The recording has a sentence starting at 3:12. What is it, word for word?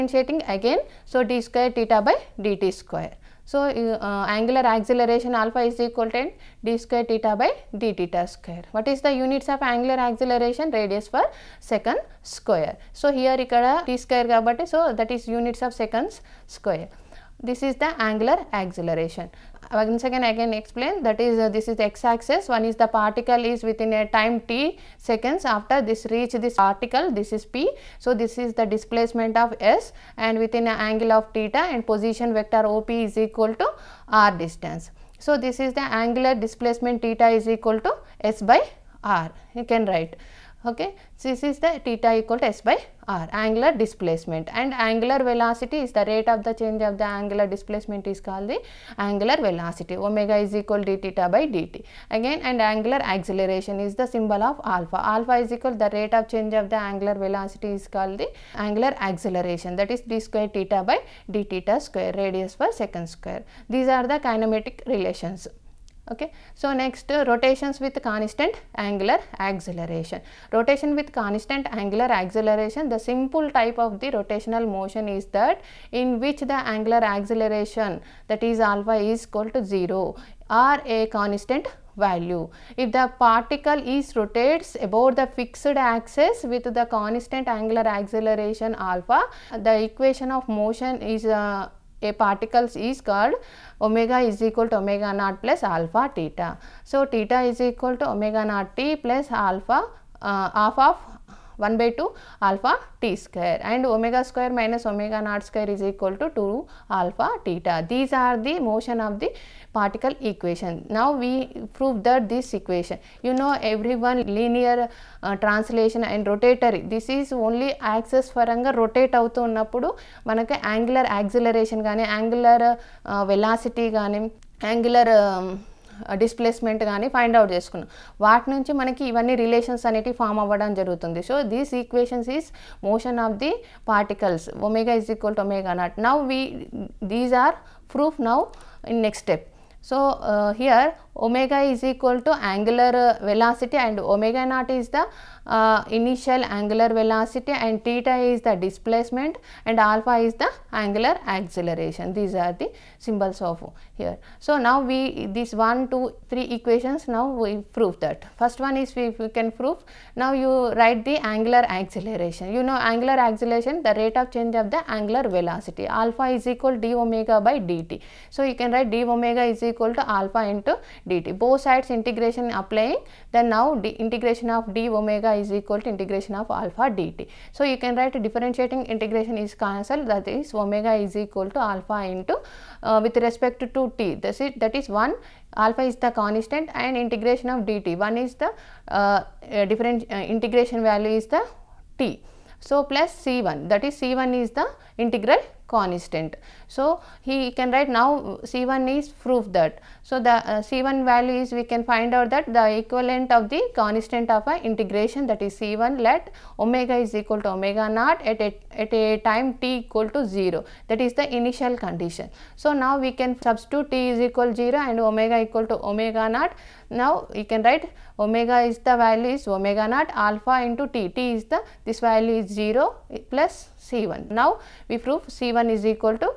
So, plus C1 that is C1 is the integral constant.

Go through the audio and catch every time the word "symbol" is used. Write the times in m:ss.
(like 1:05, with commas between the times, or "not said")
0:54, 2:32.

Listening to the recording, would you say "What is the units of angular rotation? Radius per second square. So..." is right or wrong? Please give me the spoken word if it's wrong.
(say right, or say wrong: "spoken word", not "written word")
wrong: "acceleration", not "rotation".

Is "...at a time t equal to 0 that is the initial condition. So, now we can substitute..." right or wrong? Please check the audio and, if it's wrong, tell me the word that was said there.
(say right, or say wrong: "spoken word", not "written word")
right.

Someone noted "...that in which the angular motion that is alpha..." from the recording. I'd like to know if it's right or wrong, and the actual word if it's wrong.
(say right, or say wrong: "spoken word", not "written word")
wrong: "acceleration", not "motion".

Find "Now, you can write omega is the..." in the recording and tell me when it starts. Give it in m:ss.
3:36.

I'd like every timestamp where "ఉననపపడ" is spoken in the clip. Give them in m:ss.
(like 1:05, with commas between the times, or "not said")
1:59.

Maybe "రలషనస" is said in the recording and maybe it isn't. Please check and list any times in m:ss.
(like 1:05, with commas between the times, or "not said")
2:09.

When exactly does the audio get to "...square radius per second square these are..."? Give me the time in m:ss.
1:01.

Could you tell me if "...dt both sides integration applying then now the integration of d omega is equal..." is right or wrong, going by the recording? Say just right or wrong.
right.